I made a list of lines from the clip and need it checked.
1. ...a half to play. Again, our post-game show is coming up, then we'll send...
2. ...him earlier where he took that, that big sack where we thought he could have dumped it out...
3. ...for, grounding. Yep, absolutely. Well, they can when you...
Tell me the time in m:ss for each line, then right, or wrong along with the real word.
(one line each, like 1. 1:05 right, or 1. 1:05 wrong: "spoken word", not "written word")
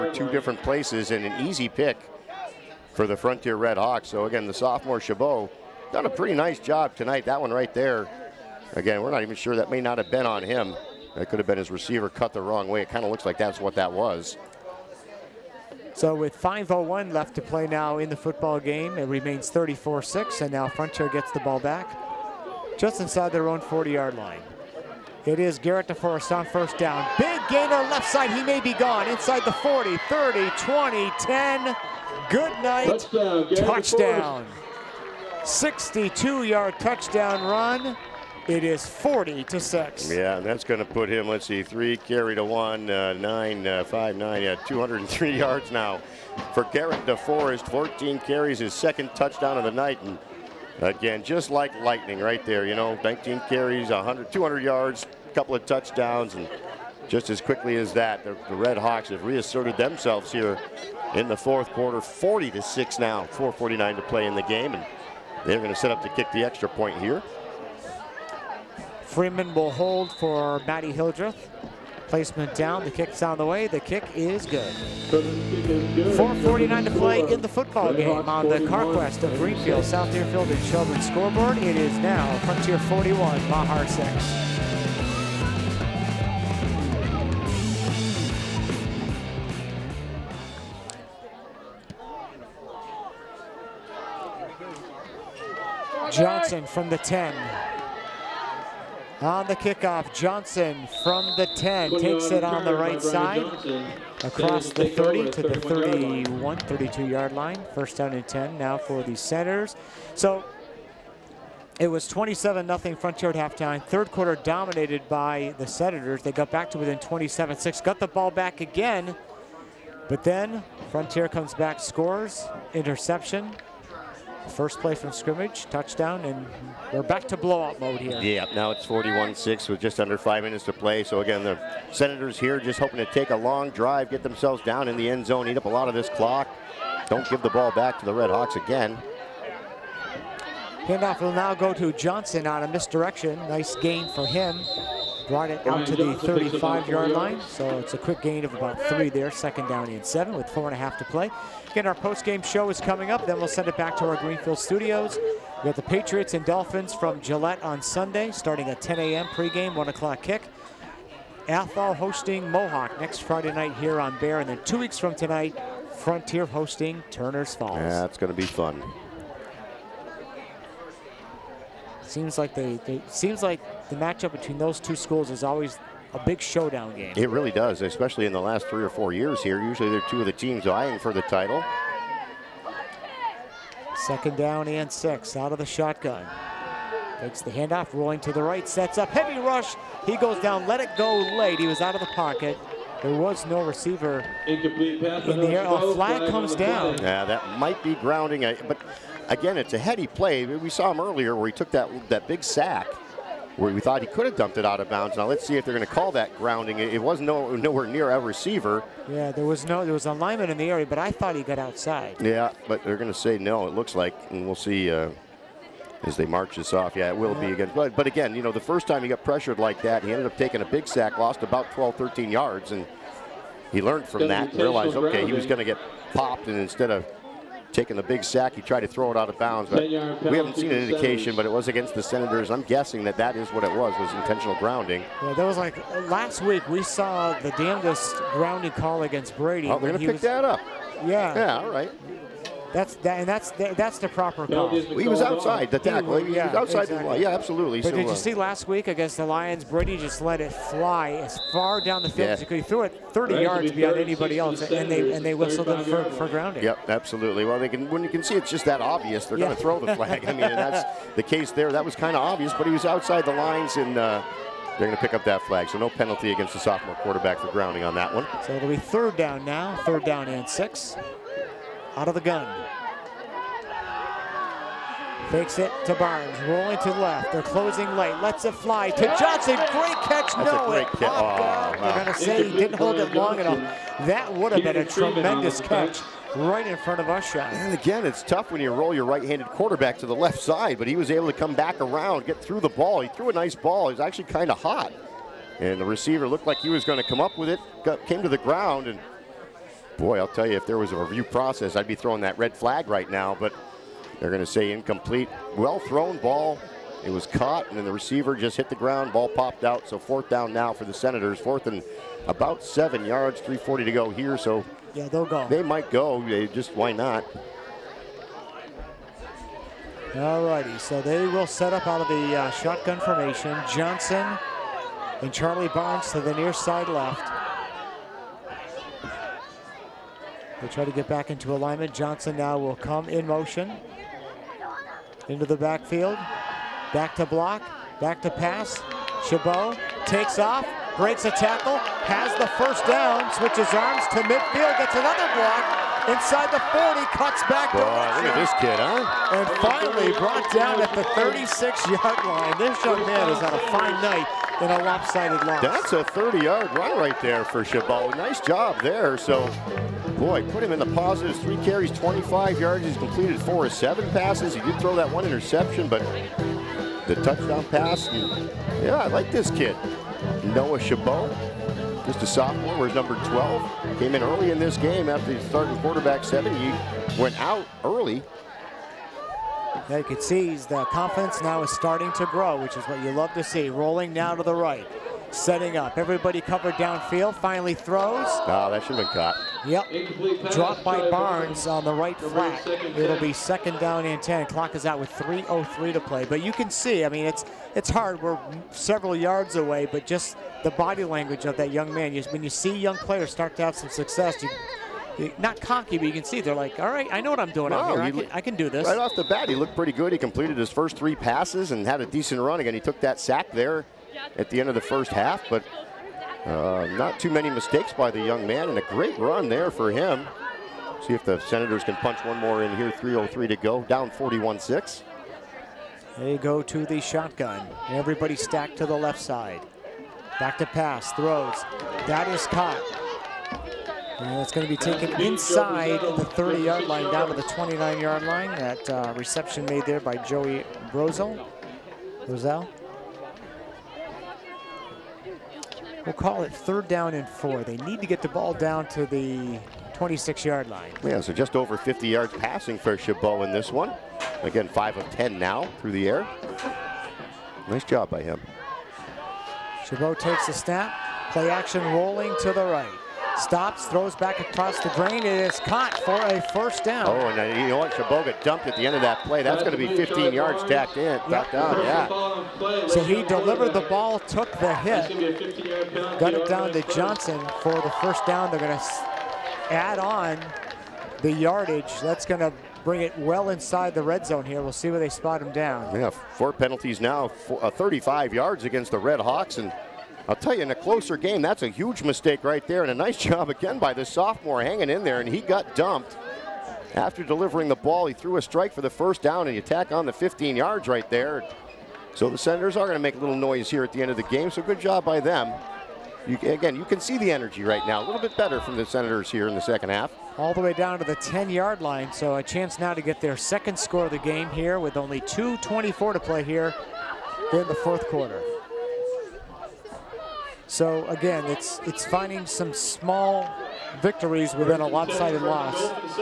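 1. 2:30 right
2. 3:20 right
3. 4:16 right.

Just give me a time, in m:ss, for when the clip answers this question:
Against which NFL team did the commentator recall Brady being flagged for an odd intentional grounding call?
4:09.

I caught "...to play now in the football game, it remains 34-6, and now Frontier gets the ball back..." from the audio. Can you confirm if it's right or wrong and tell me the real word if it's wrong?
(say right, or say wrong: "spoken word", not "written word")
right.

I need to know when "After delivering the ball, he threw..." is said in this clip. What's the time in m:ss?
8:16.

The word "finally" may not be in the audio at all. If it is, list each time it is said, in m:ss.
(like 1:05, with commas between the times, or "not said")
5:49, 6:27.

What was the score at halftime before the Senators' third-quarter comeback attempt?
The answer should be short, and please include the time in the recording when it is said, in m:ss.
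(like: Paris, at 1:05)
27-0, at 1:52.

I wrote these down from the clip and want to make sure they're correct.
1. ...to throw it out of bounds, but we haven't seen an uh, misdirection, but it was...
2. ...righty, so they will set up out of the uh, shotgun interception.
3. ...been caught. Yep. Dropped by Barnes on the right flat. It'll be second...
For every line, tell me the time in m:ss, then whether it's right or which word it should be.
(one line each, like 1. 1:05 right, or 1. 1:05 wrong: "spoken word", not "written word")
1. 3:48 wrong: "indication", not "misdirection"
2. 5:20 wrong: "formation", not "interception"
3. 6:29 right.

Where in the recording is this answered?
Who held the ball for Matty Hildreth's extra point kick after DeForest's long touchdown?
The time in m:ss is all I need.
1:09.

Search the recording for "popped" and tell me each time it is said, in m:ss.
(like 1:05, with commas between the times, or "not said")
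3:46, 4:40, 5:09.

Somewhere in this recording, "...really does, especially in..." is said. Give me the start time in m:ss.
2:57.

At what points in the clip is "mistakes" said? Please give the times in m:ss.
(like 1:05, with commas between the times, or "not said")
6:57, 8:12.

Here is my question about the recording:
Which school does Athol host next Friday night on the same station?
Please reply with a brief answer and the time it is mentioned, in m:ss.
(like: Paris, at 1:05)
Mohawk, at 2:42.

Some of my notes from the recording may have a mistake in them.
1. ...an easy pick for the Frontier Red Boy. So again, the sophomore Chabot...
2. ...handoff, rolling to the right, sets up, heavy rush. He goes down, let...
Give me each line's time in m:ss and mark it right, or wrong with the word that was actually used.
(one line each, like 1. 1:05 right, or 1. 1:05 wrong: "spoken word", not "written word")
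1. 0:01 wrong: "Hawks", not "Boy"
2. 3:07 right.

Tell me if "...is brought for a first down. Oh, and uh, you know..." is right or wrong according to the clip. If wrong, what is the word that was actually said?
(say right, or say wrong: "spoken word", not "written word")
wrong: "caught", not "brought".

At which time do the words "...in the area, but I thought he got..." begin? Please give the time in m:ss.
3:30.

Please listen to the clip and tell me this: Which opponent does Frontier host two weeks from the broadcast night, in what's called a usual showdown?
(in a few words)
Turner's Falls.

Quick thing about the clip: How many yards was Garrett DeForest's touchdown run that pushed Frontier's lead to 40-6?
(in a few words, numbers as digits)
62.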